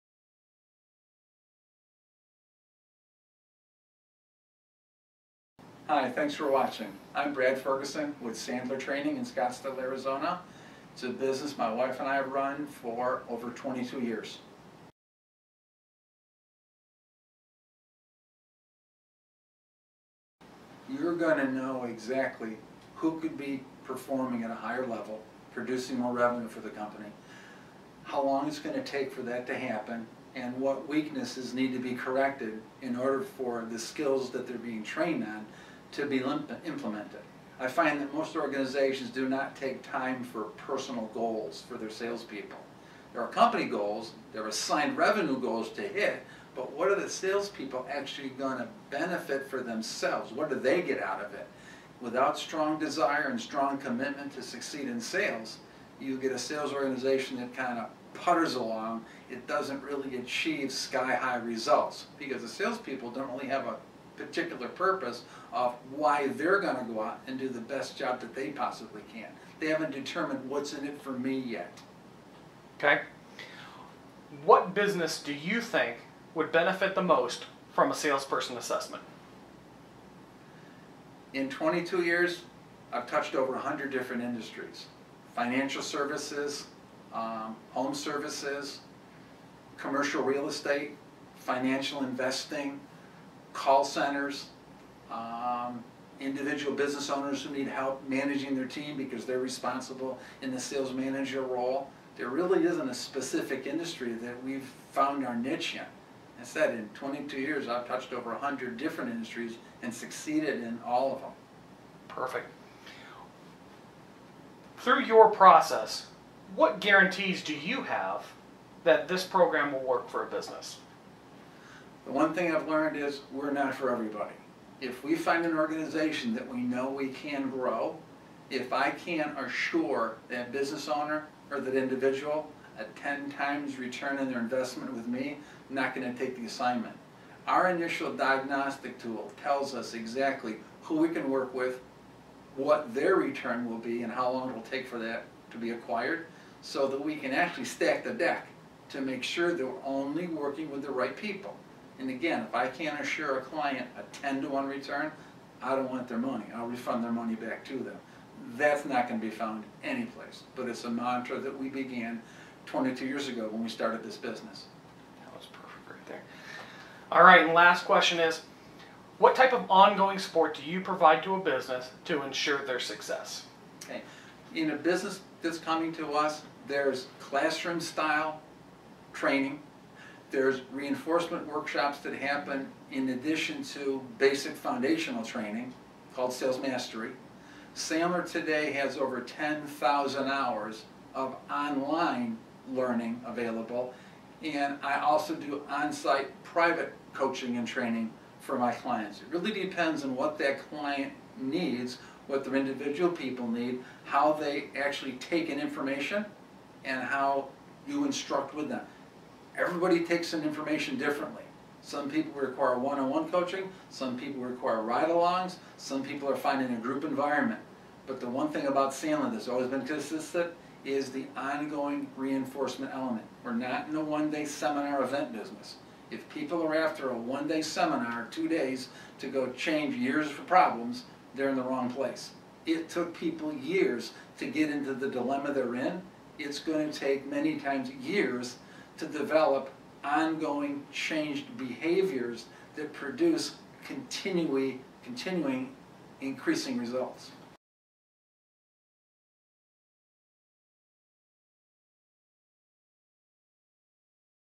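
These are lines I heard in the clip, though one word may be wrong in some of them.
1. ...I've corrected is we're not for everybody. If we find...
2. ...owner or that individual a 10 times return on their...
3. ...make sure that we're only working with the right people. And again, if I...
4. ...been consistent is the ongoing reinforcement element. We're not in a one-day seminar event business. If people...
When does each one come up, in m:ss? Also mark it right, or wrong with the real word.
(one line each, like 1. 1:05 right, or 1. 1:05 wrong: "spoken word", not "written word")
1. 2:02 wrong: "learned", not "corrected"
2. 2:10 right
3. 2:29 right
4. 3:39 right.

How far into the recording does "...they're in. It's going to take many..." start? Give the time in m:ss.
3:55.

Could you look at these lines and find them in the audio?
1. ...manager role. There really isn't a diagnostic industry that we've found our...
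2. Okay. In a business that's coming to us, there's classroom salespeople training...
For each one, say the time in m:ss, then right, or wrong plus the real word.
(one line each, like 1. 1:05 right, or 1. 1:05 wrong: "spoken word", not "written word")
1. 1:40 wrong: "specific", not "diagnostic"
2. 2:53 wrong: "style", not "salespeople".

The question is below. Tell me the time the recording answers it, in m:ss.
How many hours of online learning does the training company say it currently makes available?
3:09.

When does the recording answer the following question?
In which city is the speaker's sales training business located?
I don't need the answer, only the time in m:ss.
0:09.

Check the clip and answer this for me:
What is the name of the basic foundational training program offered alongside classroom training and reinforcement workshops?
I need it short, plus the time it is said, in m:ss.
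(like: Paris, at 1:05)
Sales Mastery, at 3:06.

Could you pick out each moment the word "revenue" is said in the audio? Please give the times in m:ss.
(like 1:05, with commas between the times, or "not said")
0:26, 0:44.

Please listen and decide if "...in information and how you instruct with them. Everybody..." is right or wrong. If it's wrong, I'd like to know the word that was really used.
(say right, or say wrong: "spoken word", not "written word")
right.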